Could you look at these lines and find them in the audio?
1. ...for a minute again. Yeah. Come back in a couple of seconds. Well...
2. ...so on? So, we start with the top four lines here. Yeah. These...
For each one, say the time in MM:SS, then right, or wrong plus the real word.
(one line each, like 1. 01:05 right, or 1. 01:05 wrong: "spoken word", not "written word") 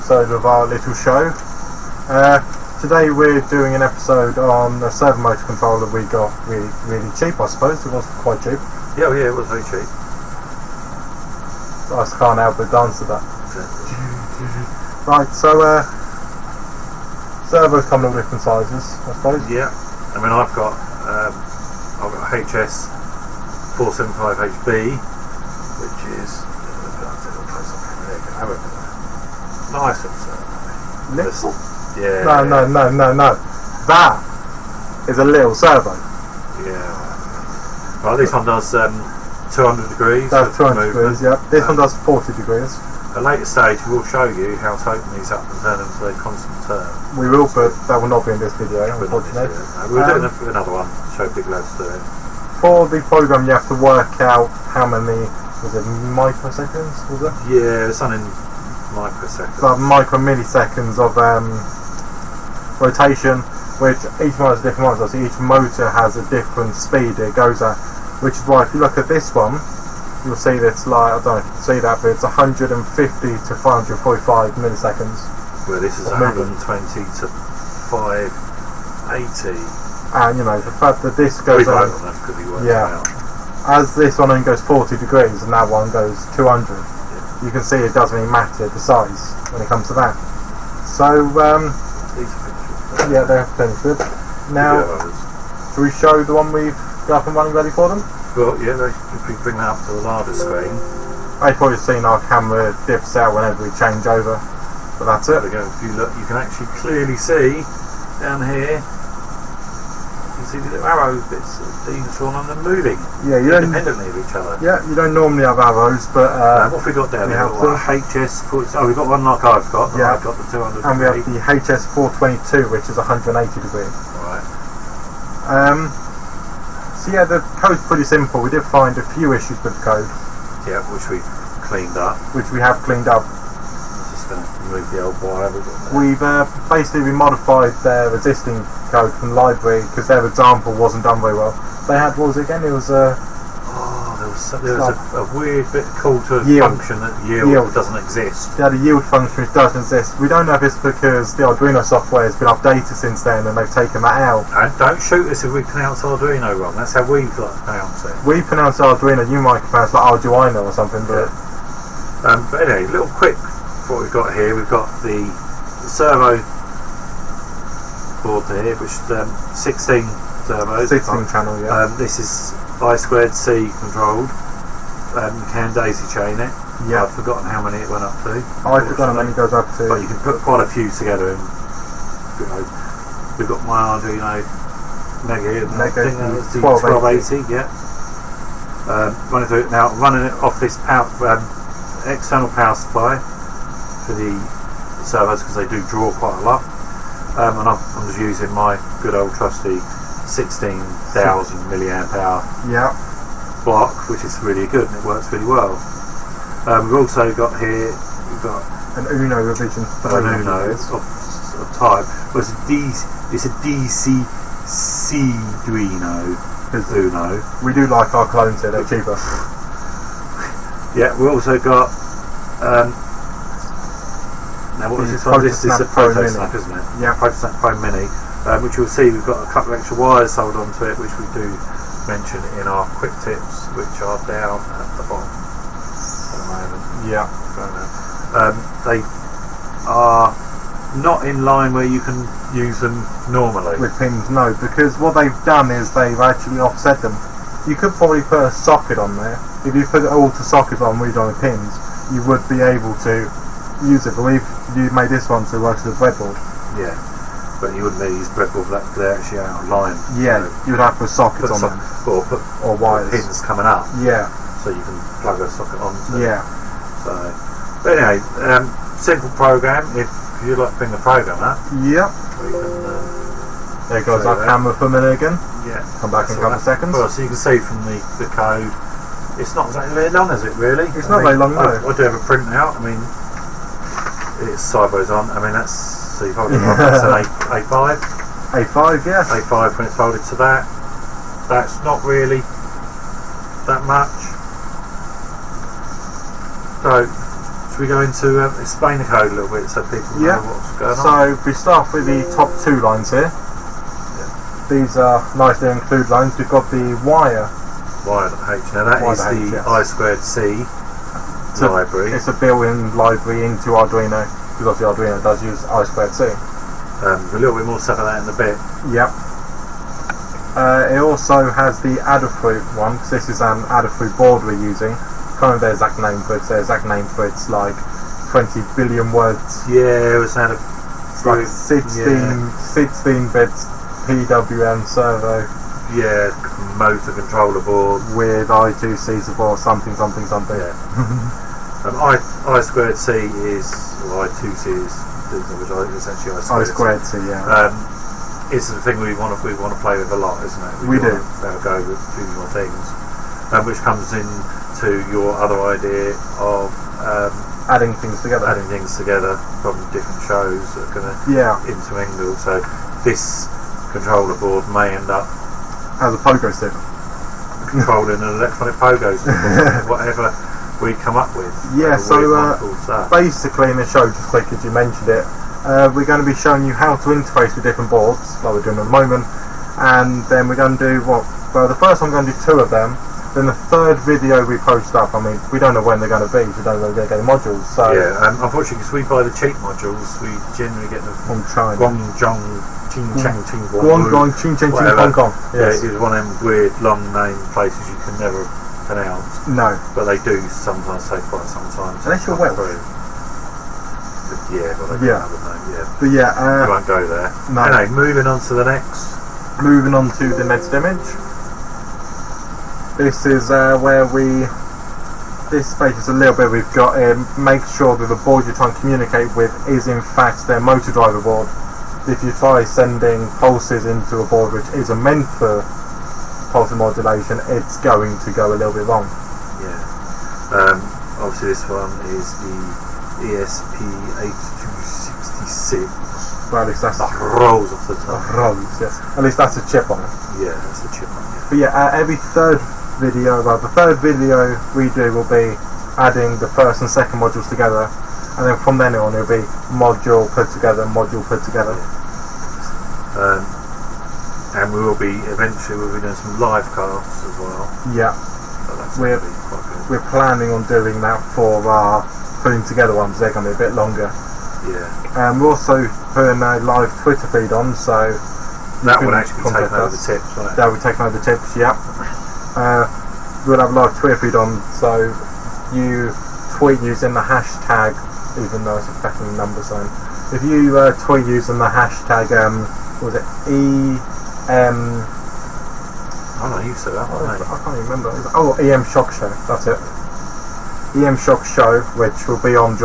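1. 04:34 right
2. 05:00 wrong: "two", not "four".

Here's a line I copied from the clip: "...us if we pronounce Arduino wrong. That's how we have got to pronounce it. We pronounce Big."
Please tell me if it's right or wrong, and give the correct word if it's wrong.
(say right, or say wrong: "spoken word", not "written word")
wrong: "Arduino", not "Big".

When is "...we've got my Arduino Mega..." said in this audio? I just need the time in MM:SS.
03:03.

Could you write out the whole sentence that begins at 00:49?
we'll um, do another one, show Big Lads it.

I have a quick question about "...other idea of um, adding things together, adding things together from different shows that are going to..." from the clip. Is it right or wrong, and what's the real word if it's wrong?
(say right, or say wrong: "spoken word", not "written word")
right.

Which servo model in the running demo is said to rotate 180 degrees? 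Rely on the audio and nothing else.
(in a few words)
HS 422.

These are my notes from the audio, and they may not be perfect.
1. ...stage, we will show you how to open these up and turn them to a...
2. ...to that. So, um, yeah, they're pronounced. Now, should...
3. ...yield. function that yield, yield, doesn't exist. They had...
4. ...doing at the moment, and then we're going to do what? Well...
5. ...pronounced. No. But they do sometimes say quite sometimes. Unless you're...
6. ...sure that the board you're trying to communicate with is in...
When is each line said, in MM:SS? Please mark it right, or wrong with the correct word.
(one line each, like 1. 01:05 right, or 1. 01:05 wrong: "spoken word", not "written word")
1. 00:43 right
2. 01:29 wrong: "finished", not "pronounced"
3. 02:26 right
4. 06:18 right
5. 06:38 right
6. 06:57 right.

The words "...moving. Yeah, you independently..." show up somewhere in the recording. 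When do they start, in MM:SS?
01:52.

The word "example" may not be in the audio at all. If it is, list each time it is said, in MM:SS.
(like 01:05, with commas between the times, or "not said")
02:20.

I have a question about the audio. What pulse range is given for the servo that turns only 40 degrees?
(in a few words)
150 to 545.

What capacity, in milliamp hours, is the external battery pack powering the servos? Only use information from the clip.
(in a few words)
16,000.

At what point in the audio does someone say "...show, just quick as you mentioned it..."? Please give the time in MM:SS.
06:13.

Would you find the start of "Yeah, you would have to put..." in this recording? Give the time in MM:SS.
04:20.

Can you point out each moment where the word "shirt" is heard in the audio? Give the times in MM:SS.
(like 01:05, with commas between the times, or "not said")
not said.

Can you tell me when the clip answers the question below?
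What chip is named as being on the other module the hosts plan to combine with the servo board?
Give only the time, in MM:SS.
07:13.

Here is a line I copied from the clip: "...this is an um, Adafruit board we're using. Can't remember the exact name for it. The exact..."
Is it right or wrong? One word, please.
right.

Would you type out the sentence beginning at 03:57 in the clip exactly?
Yeah, um, they are not in line where you can use them normally with pins.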